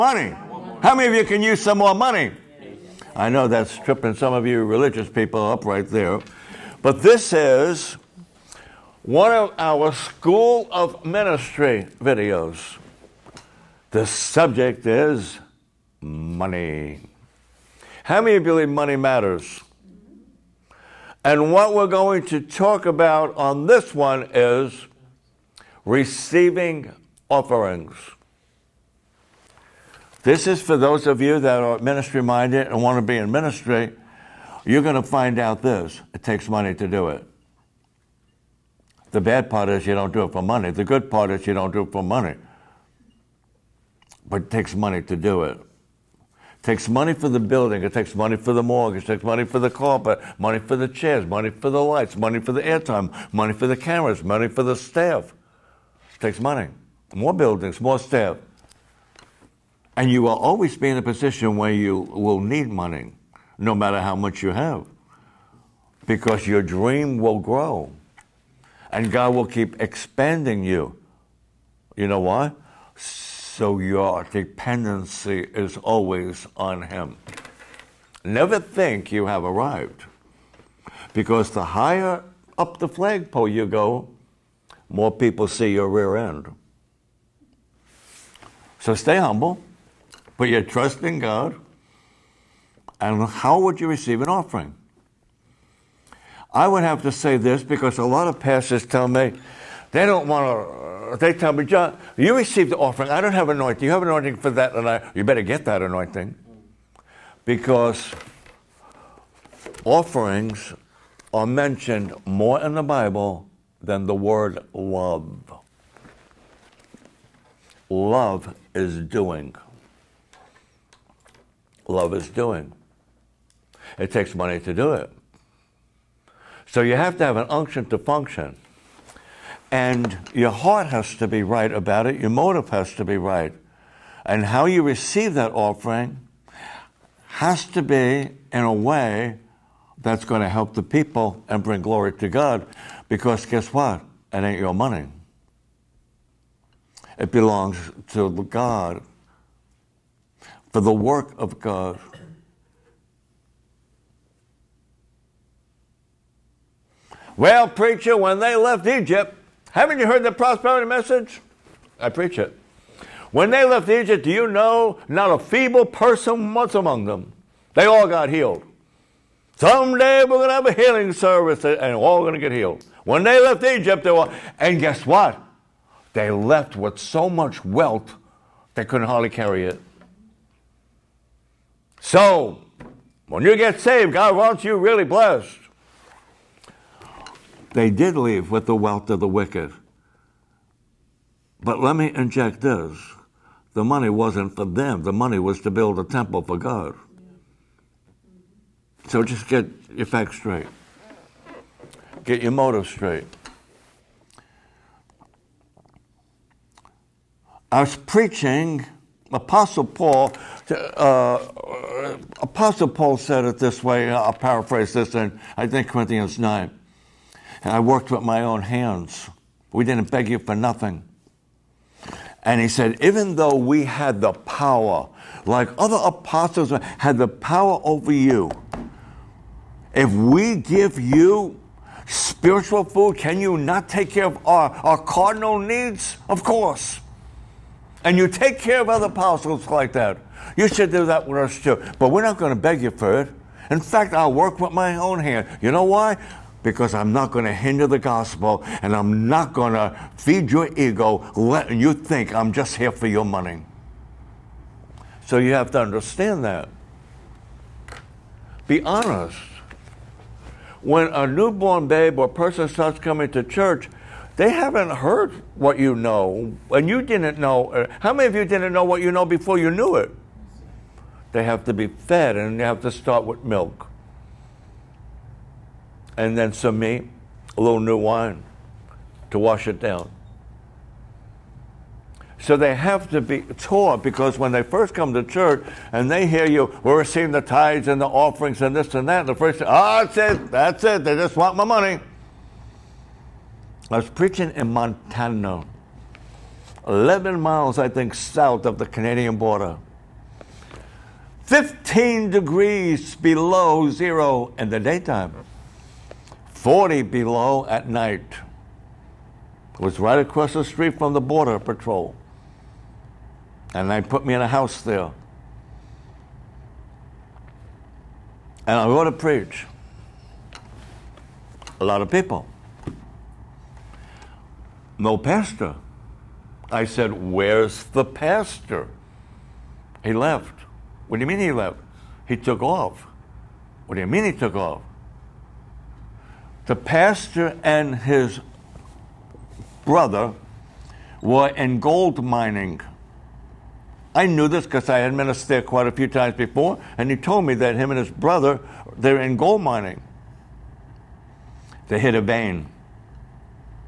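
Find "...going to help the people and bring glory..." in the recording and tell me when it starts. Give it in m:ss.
2:20.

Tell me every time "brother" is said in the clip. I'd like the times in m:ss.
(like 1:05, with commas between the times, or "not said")
5:39, 5:48.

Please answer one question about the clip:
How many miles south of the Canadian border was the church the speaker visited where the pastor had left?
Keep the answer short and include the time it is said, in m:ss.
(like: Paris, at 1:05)
11, at 4:56.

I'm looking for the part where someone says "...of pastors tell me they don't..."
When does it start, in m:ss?
1:38.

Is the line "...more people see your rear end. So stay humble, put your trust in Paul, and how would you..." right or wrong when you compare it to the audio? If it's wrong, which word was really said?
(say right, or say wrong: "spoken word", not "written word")
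wrong: "God", not "Paul".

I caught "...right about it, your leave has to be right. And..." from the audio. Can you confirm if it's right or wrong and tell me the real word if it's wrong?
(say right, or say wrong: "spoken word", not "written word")
wrong: "motive", not "leave".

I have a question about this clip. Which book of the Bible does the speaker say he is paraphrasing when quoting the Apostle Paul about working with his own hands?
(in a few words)
Corinthians.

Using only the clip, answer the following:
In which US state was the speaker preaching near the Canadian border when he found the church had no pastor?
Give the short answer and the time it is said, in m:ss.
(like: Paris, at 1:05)
Montana, at 4:54.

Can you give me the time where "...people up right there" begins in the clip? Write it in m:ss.
0:05.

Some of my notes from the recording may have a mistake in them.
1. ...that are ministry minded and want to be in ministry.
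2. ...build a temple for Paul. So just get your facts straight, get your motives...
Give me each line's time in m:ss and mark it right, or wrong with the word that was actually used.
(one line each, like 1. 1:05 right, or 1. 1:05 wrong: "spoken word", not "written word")
1. 0:31 right
2. 3:15 wrong: "God", not "Paul".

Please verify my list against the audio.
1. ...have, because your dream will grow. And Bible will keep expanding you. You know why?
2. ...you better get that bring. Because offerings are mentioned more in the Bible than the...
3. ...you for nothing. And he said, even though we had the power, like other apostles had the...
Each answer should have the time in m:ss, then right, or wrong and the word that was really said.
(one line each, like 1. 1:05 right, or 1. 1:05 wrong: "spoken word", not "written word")
1. 1:04 wrong: "God", not "Bible"
2. 1:45 wrong: "anointing", not "bring"
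3. 3:40 right.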